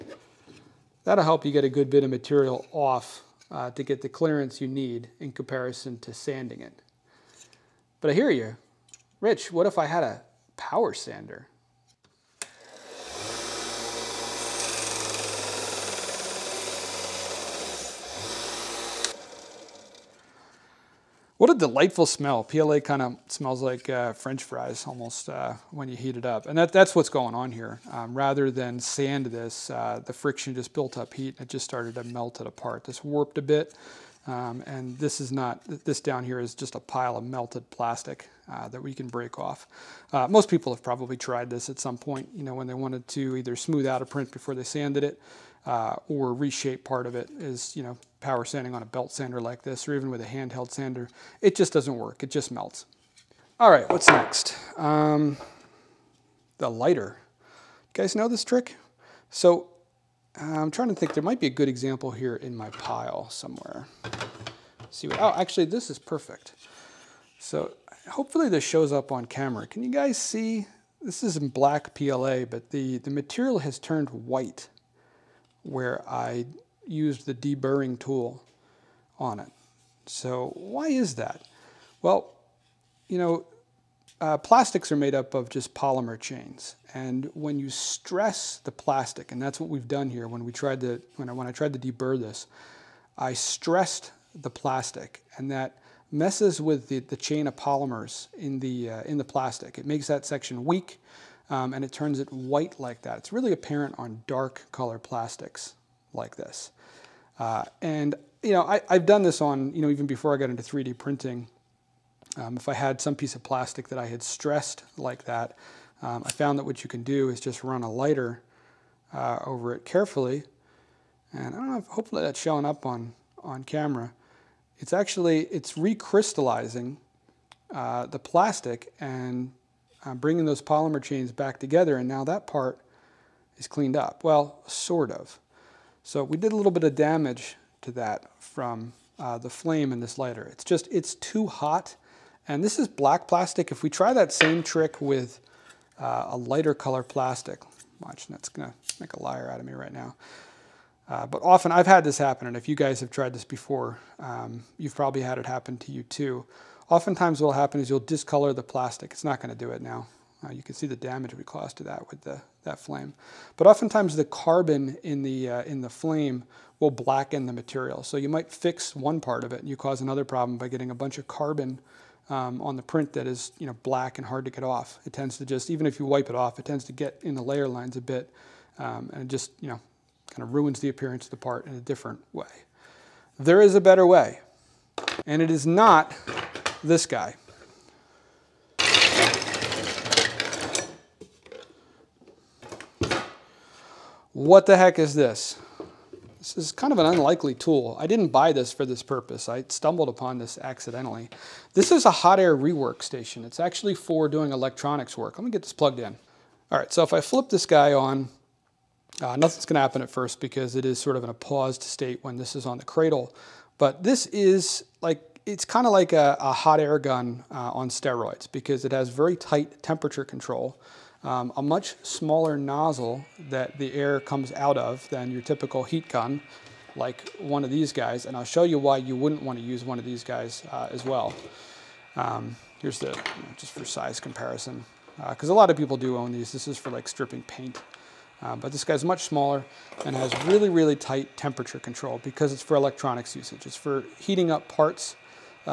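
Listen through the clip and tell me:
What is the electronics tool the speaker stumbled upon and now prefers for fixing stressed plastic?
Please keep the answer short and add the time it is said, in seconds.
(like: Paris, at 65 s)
hot air rework station, at 202 s.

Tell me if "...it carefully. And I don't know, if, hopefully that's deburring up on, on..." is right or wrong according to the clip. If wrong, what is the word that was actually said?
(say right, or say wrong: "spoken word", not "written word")
wrong: "showing", not "deburring".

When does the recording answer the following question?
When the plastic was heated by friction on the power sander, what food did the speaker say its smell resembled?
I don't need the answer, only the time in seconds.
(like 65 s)
24 s.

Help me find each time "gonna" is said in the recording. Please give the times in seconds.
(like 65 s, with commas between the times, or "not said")
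148 s, 209 s.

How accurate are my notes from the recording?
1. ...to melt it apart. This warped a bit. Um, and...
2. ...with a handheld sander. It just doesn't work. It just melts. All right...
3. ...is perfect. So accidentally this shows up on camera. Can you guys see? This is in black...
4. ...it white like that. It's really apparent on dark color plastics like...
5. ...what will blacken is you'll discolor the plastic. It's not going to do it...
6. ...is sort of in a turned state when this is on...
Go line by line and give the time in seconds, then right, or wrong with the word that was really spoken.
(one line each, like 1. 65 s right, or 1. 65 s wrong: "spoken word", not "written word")
1. 31 s right
2. 50 s right
3. 65 s wrong: "hopefully", not "accidentally"
4. 102 s right
5. 157 s wrong: "happen", not "blacken"
6. 210 s wrong: "paused", not "turned".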